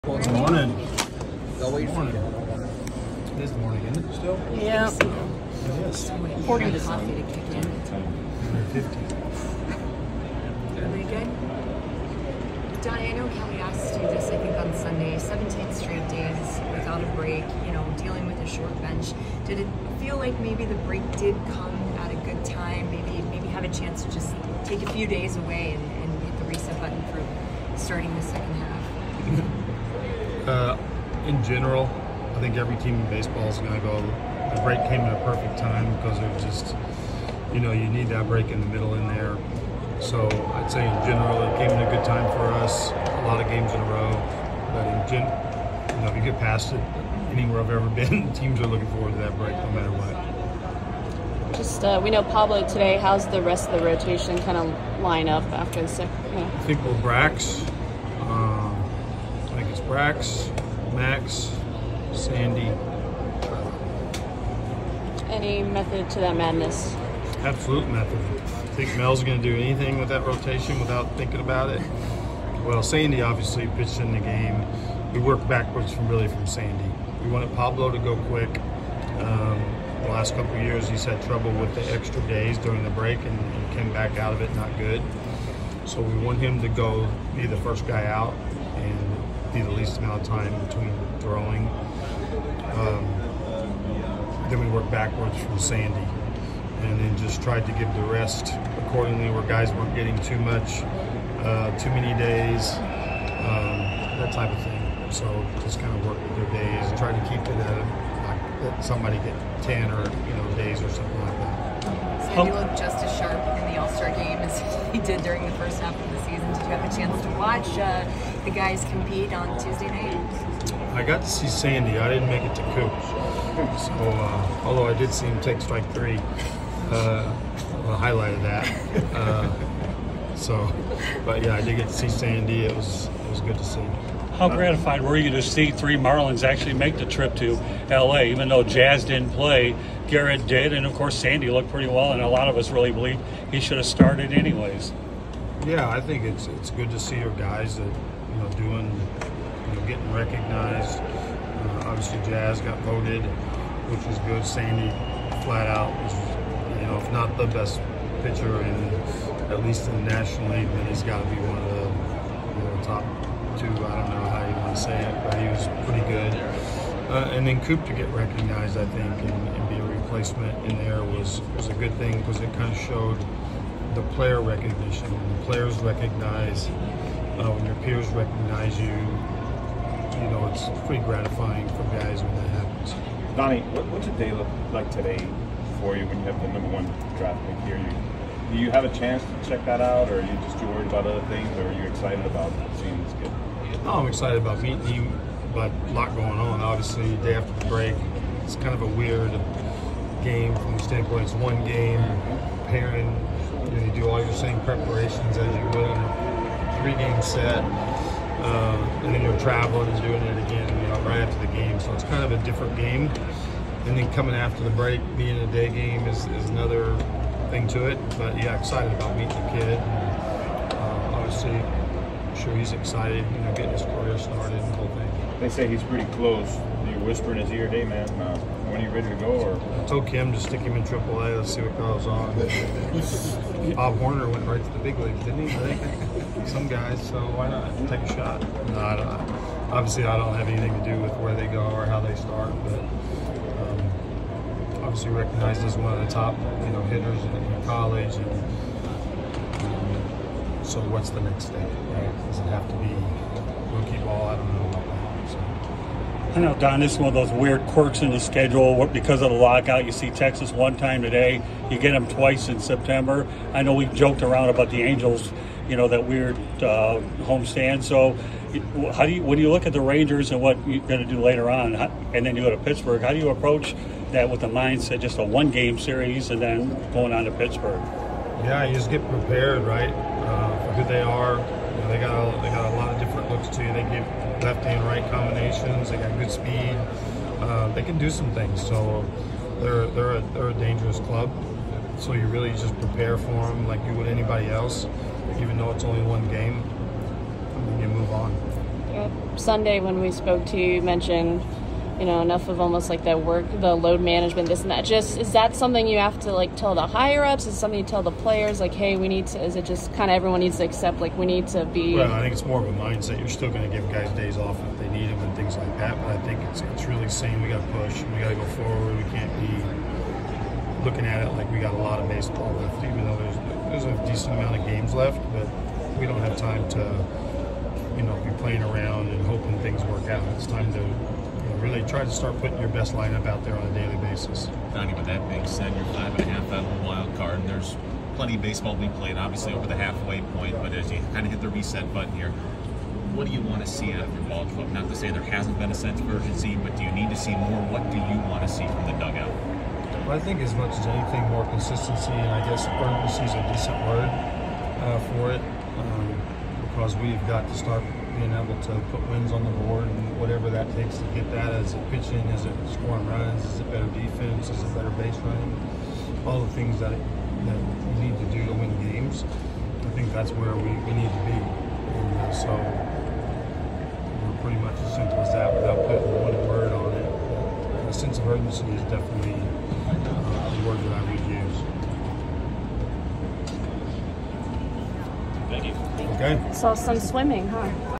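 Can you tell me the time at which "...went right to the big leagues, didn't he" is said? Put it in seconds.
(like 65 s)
234 s.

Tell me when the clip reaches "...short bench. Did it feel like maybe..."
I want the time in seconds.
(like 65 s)
18 s.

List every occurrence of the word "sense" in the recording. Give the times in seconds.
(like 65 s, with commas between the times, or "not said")
345 s, 377 s.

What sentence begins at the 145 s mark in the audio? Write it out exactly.
Yeah, I think it's it's good to see your guys that you know, doing, you know, getting recognized.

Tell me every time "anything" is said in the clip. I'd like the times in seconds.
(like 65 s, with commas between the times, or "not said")
69 s, 240 s, 350 s.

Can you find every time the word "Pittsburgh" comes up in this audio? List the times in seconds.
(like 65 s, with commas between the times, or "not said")
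272 s, 277 s.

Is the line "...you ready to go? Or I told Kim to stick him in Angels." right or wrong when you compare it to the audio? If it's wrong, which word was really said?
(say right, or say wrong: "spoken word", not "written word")
wrong: "AAA", not "Angels".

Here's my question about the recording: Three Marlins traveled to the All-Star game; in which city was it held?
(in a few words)
LA.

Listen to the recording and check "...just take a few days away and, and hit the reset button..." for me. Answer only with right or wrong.
right.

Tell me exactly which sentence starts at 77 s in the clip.
We wanted Pablo to go quick.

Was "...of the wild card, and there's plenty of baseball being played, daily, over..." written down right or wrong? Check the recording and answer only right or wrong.
wrong.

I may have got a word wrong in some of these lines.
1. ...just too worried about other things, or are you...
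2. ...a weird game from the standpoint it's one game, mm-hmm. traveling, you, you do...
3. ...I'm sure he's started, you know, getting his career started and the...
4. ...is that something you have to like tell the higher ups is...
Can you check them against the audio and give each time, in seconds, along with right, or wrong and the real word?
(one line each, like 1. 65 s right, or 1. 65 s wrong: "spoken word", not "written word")
1. 190 s right
2. 198 s wrong: "pairing", not "traveling"
3. 221 s wrong: "excited", not "started"
4. 305 s right.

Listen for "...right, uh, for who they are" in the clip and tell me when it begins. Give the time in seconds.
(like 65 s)
279 s.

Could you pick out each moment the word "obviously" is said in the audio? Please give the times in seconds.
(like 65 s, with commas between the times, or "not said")
73 s, 151 s, 196 s, 221 s, 239 s, 244 s, 339 s.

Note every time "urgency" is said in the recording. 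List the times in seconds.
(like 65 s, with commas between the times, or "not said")
346 s, 352 s, 378 s.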